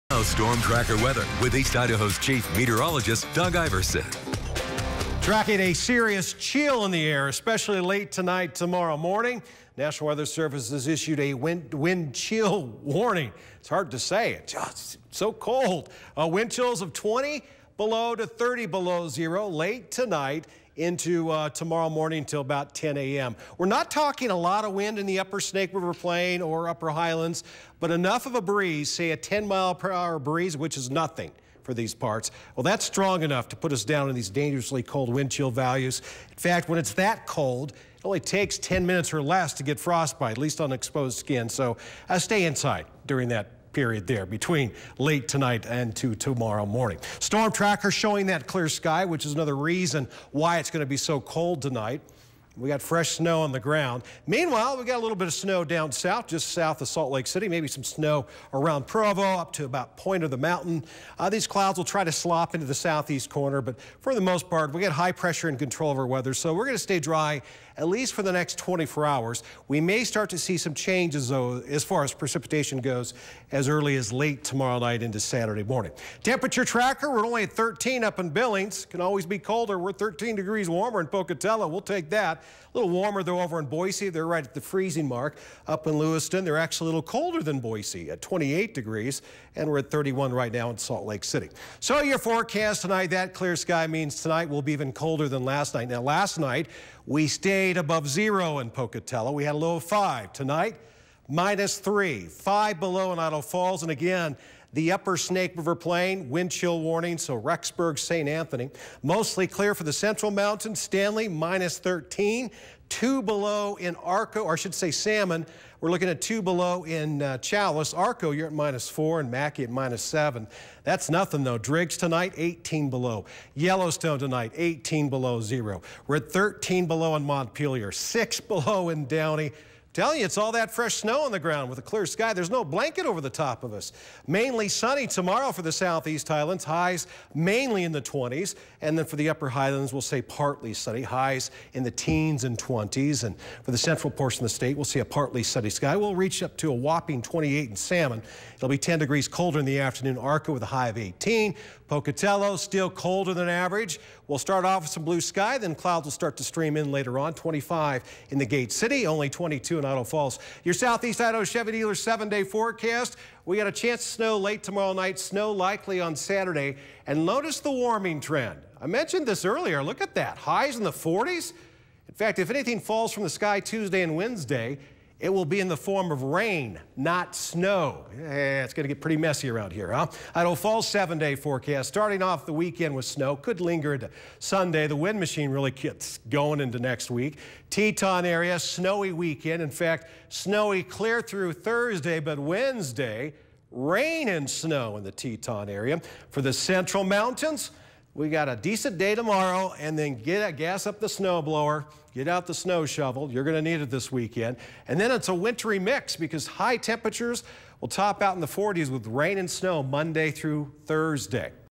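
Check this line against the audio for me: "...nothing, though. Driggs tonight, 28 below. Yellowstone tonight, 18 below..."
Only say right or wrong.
wrong.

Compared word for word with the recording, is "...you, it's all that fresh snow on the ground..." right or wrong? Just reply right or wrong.
right.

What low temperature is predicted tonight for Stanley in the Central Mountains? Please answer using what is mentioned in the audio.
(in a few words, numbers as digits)
-13.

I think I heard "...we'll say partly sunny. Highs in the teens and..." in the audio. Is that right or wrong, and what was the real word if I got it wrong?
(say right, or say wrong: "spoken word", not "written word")
right.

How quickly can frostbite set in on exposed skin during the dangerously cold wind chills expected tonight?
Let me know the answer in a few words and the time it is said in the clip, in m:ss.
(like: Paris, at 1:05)
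10 minutes or less, at 0:38.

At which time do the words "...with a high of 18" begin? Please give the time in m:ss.
2:30.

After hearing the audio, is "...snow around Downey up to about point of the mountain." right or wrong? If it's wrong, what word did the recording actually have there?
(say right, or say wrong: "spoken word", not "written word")
wrong: "Provo", not "Downey".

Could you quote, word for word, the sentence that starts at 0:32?
Well, that's strong enough to put us down in these dangerously cold wind chill values.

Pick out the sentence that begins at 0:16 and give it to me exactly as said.
Uh, wind chills of 20 below to 30 below zero late tonight into uh, tomorrow morning till about 10 a.m.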